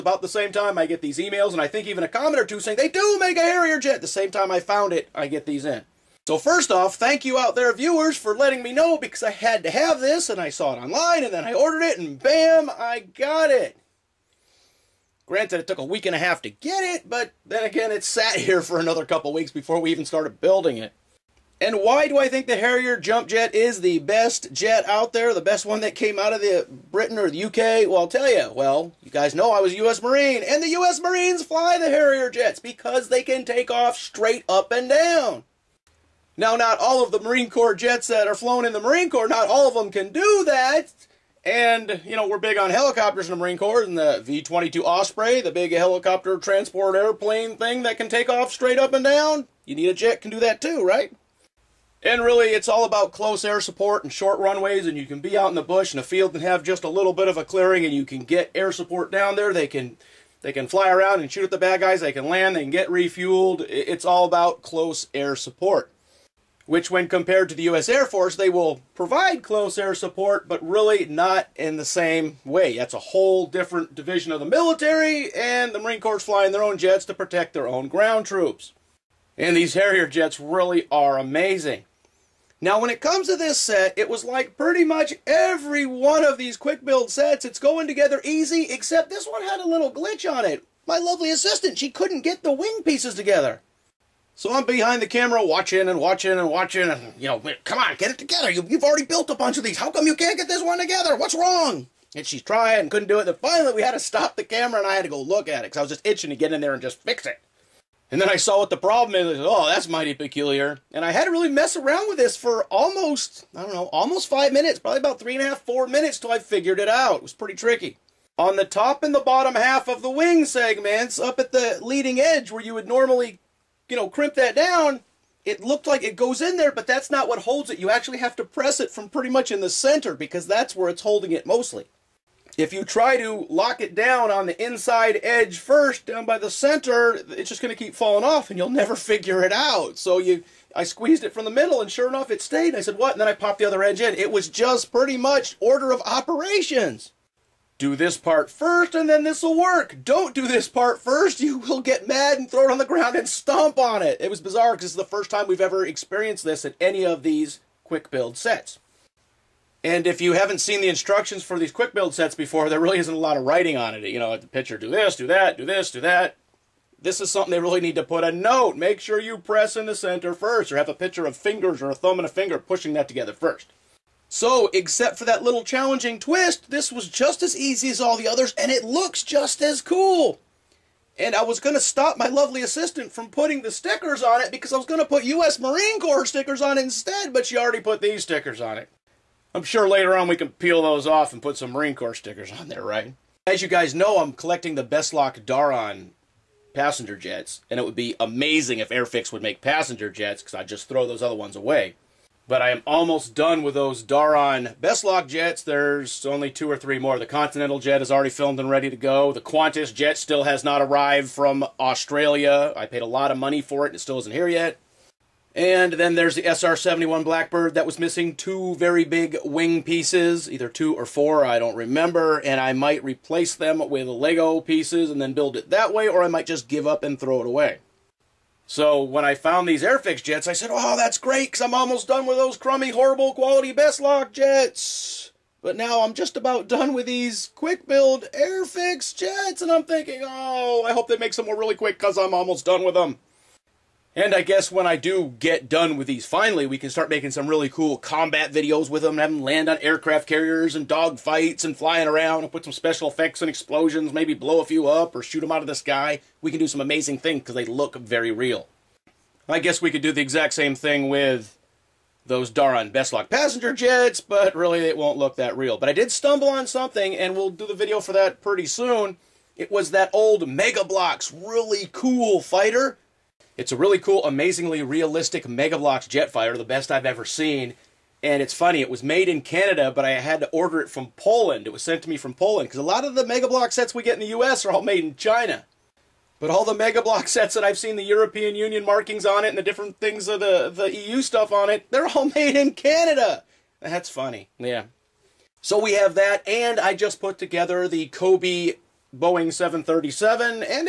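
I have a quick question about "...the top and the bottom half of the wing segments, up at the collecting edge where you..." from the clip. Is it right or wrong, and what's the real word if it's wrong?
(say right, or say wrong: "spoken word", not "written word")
wrong: "leading", not "collecting".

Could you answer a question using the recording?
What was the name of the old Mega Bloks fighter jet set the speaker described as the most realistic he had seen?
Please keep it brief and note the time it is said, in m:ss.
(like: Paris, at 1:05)
Jetfire, at 4:35.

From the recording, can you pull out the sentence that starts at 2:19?
So you, I squeezed it from the middle and sure enough it stayed.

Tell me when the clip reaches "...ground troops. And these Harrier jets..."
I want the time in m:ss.
1:17.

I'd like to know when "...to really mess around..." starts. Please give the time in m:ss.
1:51.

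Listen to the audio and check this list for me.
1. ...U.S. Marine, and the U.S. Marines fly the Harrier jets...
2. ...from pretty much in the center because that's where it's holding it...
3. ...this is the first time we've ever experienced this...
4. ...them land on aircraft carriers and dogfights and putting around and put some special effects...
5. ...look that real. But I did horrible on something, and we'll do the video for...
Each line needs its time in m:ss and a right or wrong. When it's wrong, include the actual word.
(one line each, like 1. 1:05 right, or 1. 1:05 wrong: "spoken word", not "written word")
1. 0:29 right
2. 2:08 right
3. 2:34 right
4. 4:09 wrong: "flying", not "putting"
5. 4:25 wrong: "stumble", not "horrible".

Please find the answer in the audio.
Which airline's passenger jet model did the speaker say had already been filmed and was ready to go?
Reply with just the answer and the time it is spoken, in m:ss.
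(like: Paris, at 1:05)
Continental, at 3:27.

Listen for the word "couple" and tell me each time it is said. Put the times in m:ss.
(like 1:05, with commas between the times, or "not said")
0:19.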